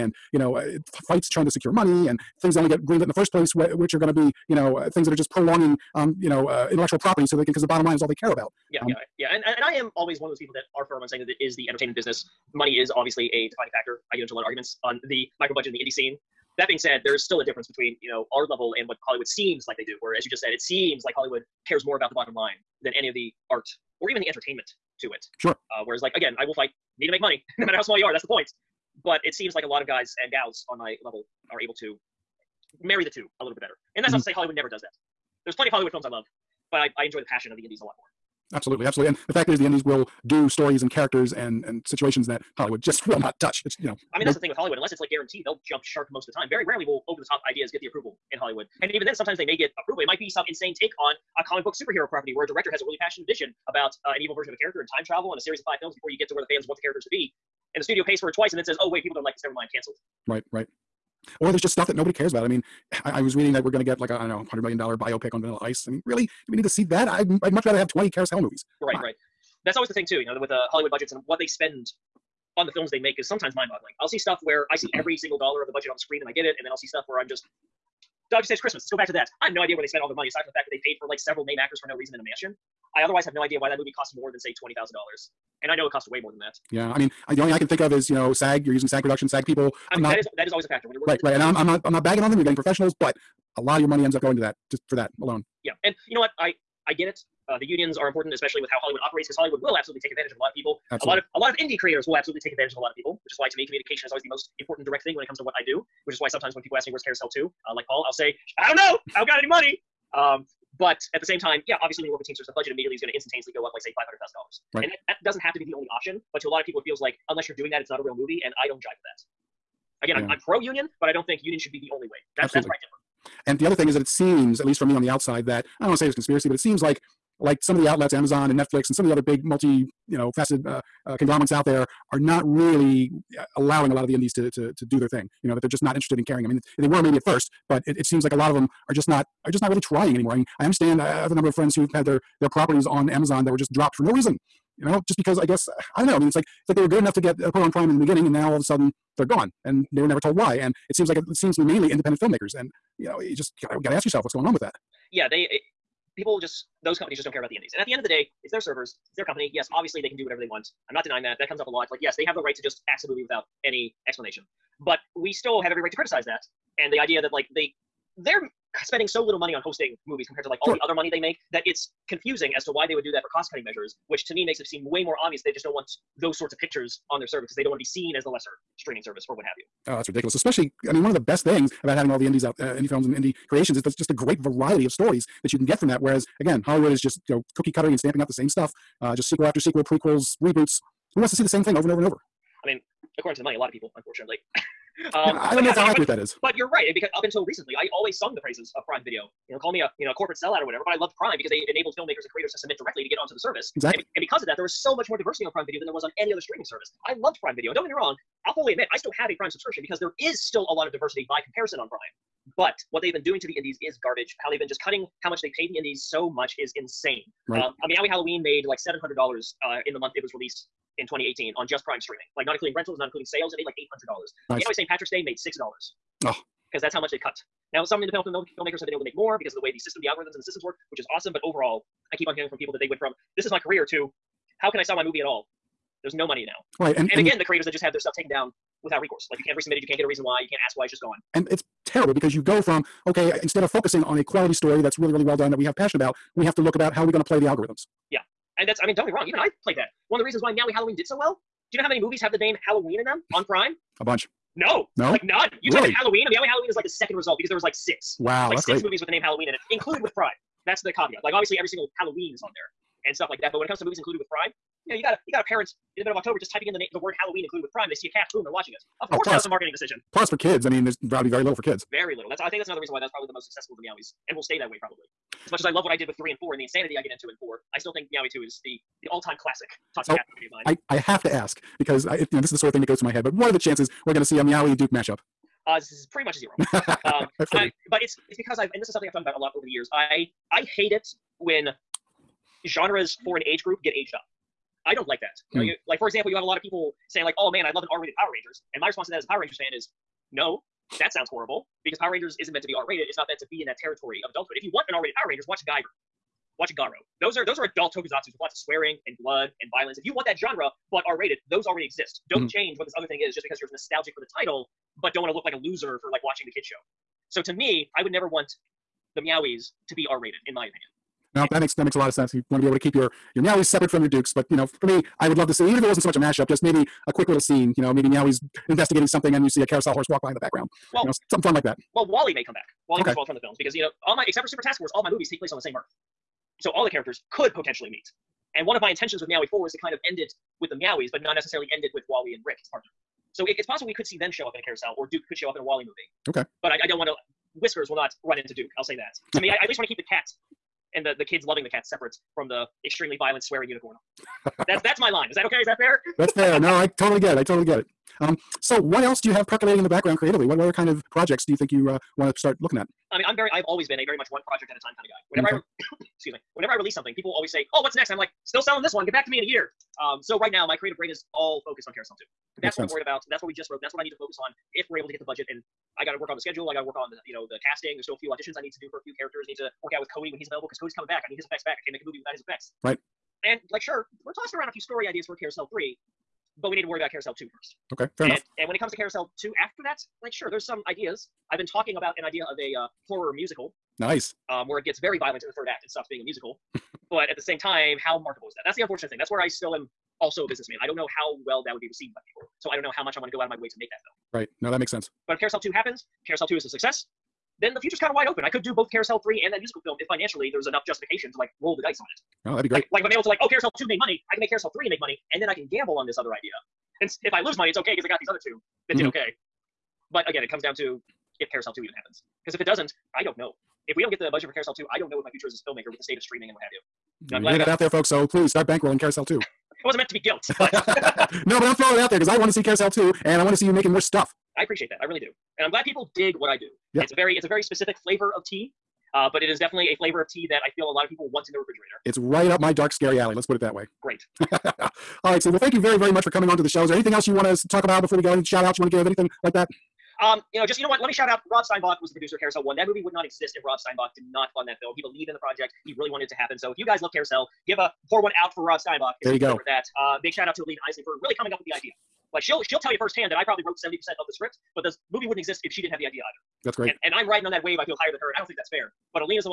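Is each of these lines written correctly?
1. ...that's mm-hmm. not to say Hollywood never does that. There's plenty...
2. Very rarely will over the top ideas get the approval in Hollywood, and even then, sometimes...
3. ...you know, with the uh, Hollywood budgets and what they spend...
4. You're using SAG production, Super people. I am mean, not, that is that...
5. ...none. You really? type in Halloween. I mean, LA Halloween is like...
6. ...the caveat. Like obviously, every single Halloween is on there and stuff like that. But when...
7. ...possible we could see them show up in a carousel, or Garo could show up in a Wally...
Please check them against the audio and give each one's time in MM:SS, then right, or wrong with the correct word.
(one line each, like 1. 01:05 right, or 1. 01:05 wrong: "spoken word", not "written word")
1. 00:34 right
2. 00:46 right
3. 01:10 right
4. 01:28 wrong: "SAG", not "Super"
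5. 04:15 right
6. 04:20 right
7. 05:43 wrong: "Duke", not "Garo".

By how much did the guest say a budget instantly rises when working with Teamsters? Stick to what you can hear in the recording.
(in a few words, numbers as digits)
$500,000.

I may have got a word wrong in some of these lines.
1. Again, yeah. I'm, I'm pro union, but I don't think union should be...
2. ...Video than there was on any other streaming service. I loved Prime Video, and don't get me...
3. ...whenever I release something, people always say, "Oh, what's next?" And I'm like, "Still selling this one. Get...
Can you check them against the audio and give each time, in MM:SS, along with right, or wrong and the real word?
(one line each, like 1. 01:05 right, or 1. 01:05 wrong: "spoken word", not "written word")
1. 02:00 right
2. 03:25 right
3. 06:06 right.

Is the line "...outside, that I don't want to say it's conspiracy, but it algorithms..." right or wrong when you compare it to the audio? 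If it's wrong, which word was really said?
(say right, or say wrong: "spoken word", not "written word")
wrong: "seems", not "algorithms".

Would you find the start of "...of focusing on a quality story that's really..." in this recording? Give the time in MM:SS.
04:03.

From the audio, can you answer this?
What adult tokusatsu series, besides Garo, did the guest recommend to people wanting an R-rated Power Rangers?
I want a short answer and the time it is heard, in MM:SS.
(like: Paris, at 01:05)
Guyver, at 05:05.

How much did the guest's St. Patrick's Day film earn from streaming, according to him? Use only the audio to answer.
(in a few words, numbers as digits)
$6.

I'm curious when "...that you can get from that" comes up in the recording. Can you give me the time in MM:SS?
03:05.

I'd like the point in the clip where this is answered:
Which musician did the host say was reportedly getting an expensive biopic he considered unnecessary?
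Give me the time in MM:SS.
01:05.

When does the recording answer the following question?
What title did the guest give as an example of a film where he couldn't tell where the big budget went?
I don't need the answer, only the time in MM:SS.
01:18.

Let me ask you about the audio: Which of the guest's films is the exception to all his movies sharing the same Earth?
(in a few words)
Super Task Force.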